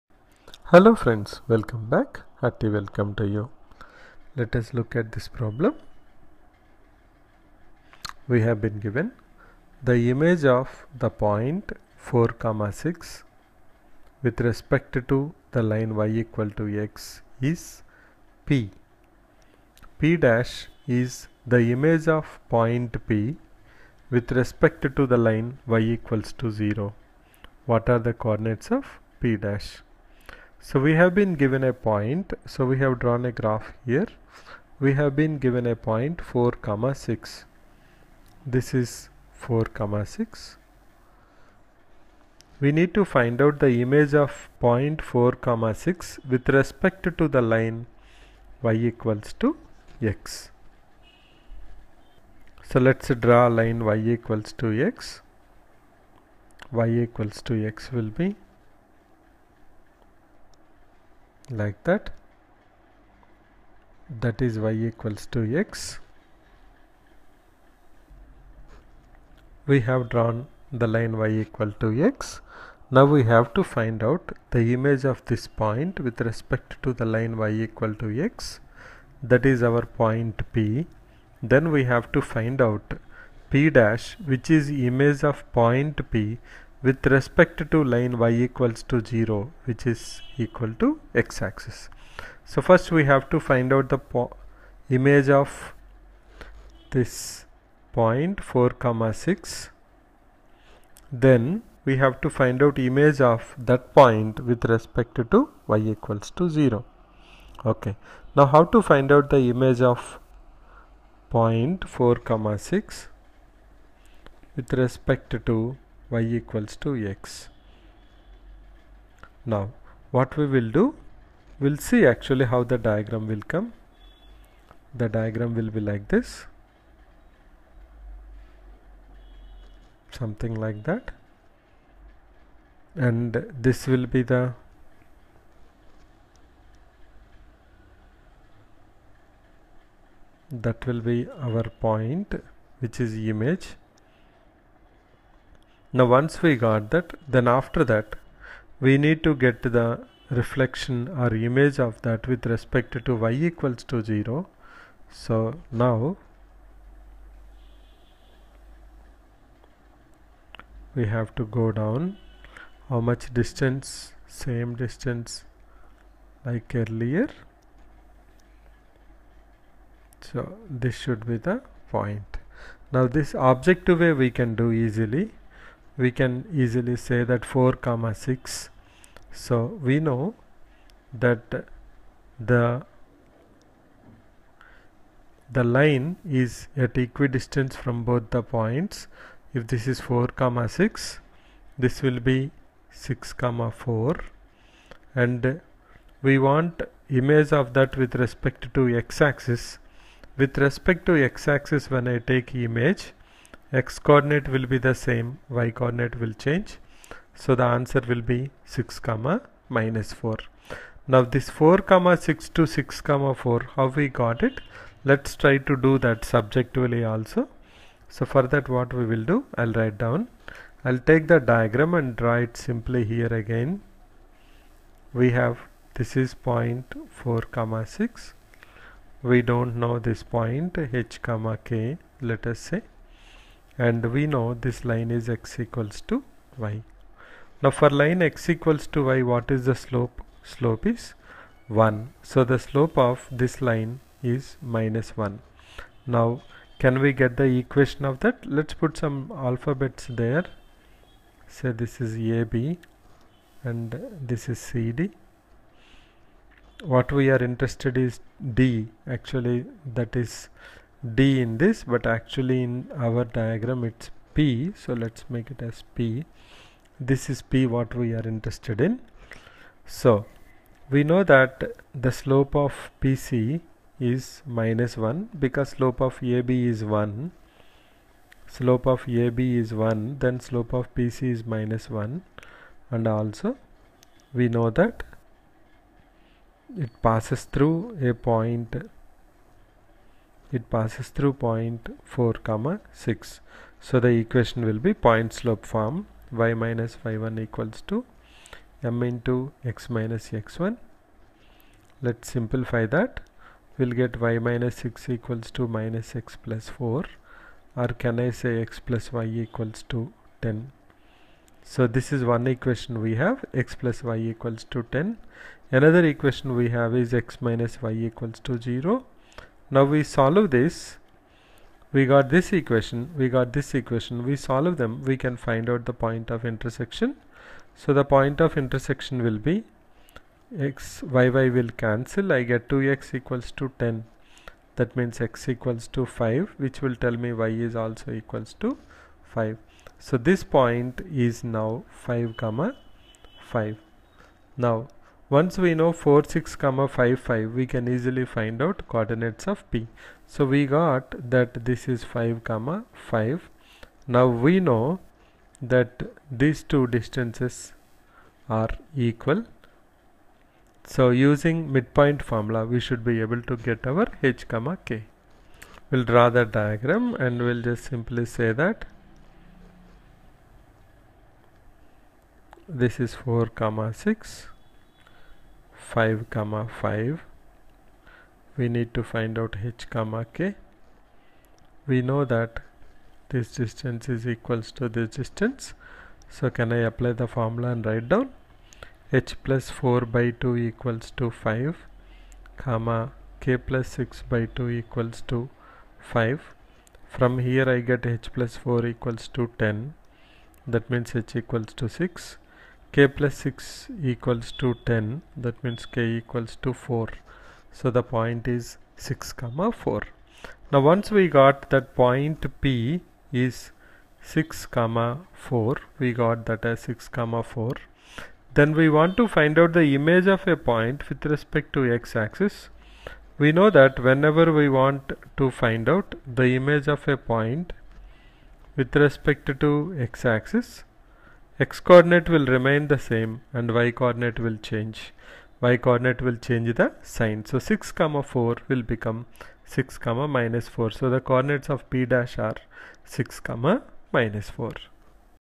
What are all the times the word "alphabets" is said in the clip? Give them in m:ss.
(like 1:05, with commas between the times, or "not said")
4:09.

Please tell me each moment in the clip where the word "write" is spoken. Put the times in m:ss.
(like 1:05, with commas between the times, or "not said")
3:39, 6:27.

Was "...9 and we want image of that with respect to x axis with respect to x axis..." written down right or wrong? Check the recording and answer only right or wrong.
wrong.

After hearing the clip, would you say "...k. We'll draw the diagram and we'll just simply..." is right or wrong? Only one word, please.
right.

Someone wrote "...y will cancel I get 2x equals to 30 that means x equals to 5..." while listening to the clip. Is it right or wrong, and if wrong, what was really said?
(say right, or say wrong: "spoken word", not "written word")
wrong: "10", not "30".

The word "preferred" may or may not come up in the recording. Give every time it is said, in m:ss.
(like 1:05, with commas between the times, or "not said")
not said.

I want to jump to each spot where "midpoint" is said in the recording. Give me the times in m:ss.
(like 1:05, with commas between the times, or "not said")
6:01.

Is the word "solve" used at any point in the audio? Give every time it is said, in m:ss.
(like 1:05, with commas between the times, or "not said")
5:20, 5:24.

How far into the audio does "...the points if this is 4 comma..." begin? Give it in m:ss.
3:08.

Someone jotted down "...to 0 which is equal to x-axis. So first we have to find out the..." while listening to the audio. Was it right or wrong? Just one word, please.
right.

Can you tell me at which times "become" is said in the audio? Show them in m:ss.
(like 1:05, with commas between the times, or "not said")
7:18.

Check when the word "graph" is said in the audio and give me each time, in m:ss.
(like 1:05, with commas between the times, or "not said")
0:33.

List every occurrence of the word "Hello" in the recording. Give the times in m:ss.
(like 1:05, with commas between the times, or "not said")
0:00.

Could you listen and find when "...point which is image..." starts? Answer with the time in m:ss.
2:21.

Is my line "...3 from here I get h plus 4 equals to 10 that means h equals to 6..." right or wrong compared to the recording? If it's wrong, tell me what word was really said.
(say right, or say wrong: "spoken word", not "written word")
wrong: "5", not "3".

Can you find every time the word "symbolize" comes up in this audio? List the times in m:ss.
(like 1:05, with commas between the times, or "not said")
not said.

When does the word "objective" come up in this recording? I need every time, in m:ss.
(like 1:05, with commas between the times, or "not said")
2:53.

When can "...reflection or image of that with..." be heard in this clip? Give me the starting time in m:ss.
2:30.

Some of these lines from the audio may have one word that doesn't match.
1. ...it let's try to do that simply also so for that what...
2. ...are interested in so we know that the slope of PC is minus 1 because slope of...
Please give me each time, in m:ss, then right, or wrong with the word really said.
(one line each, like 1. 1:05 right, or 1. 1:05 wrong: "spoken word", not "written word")
1. 3:34 wrong: "subjectively", not "simply"
2. 4:28 right.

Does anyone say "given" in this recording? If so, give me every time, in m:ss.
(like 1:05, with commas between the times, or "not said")
0:08, 0:31, 0:35.